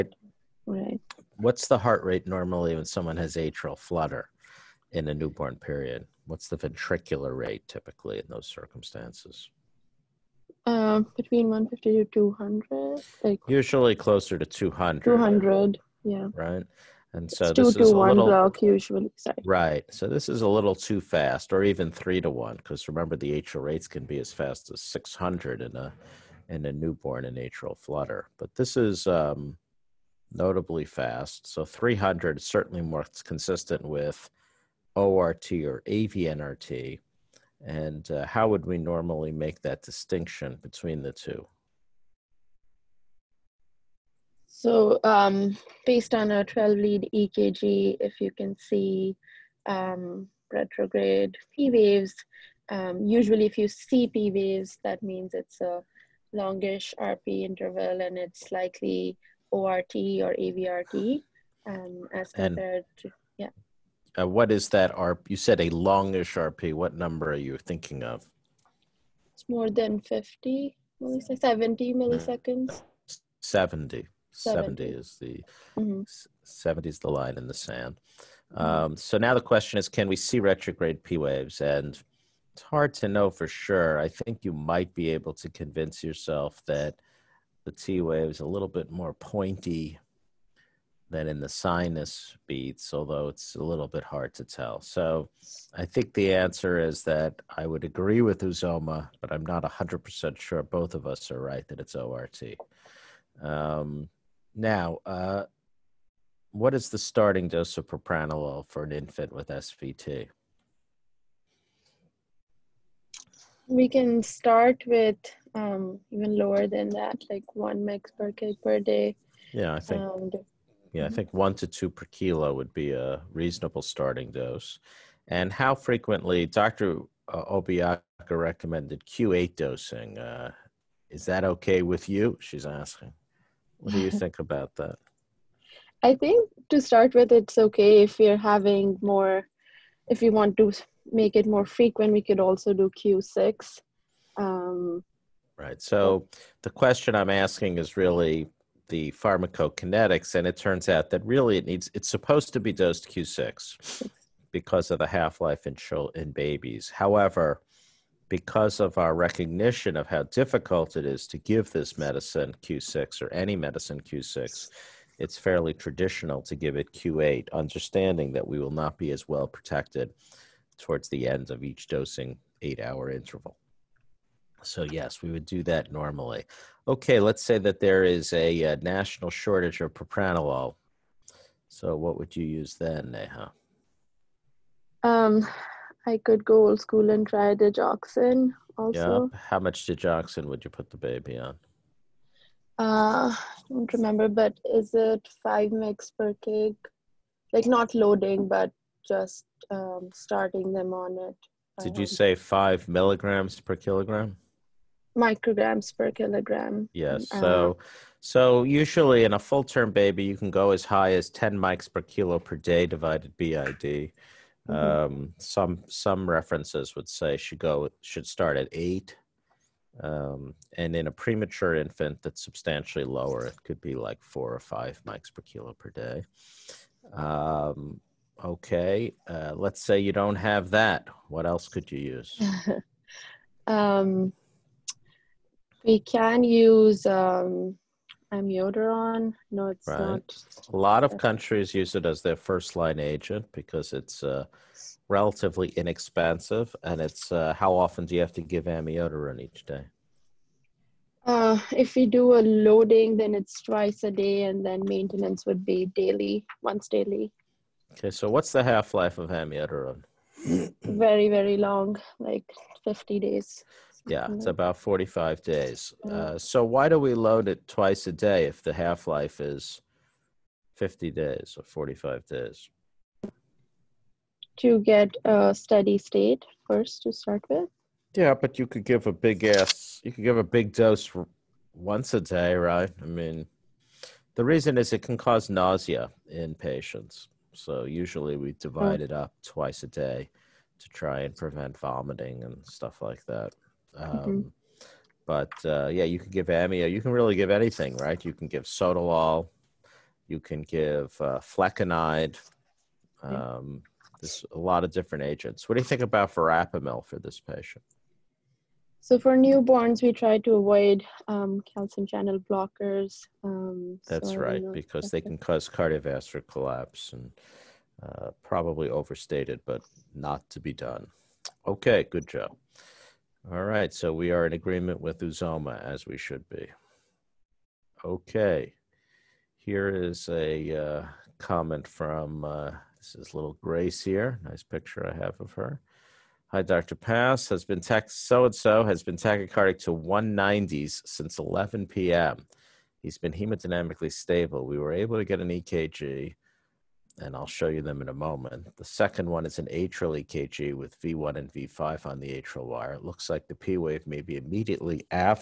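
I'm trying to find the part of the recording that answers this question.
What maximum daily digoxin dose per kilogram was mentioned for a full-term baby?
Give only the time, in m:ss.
3:31.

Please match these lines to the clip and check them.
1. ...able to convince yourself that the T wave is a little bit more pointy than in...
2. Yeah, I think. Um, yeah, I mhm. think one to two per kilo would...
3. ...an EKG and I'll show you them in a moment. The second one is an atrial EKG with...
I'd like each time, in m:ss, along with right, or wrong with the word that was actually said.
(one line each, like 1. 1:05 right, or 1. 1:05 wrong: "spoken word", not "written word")
1. 1:25 right
2. 1:59 right
3. 5:45 right.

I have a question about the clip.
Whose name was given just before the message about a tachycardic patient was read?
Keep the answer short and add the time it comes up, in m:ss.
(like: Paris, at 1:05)
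Grace, at 5:33.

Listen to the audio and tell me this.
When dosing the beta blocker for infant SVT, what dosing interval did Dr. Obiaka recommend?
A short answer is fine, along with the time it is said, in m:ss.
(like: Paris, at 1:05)
Q8, at 2:09.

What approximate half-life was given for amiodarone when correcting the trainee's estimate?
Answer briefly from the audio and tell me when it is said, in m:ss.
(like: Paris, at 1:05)
45 days, at 4:24.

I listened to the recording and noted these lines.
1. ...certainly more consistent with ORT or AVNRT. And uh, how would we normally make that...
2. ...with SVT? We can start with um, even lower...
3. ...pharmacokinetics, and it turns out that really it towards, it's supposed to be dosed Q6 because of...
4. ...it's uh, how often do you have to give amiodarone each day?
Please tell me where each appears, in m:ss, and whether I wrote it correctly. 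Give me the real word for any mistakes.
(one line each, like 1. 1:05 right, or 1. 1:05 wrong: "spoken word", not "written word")
1. 0:32 right
2. 1:49 right
3. 2:29 wrong: "needs", not "towards"
4. 4:06 right.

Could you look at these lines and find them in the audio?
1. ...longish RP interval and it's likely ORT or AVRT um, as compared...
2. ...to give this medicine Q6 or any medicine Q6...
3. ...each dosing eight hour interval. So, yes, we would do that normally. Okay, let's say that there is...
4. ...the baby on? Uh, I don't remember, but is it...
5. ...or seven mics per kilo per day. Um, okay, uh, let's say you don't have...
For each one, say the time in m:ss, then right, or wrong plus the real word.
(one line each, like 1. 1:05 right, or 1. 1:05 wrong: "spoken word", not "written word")
1. 0:56 right
2. 2:41 right
3. 2:51 right
4. 3:10 right
5. 3:44 wrong: "five", not "seven".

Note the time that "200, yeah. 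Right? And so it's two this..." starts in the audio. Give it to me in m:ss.
0:15.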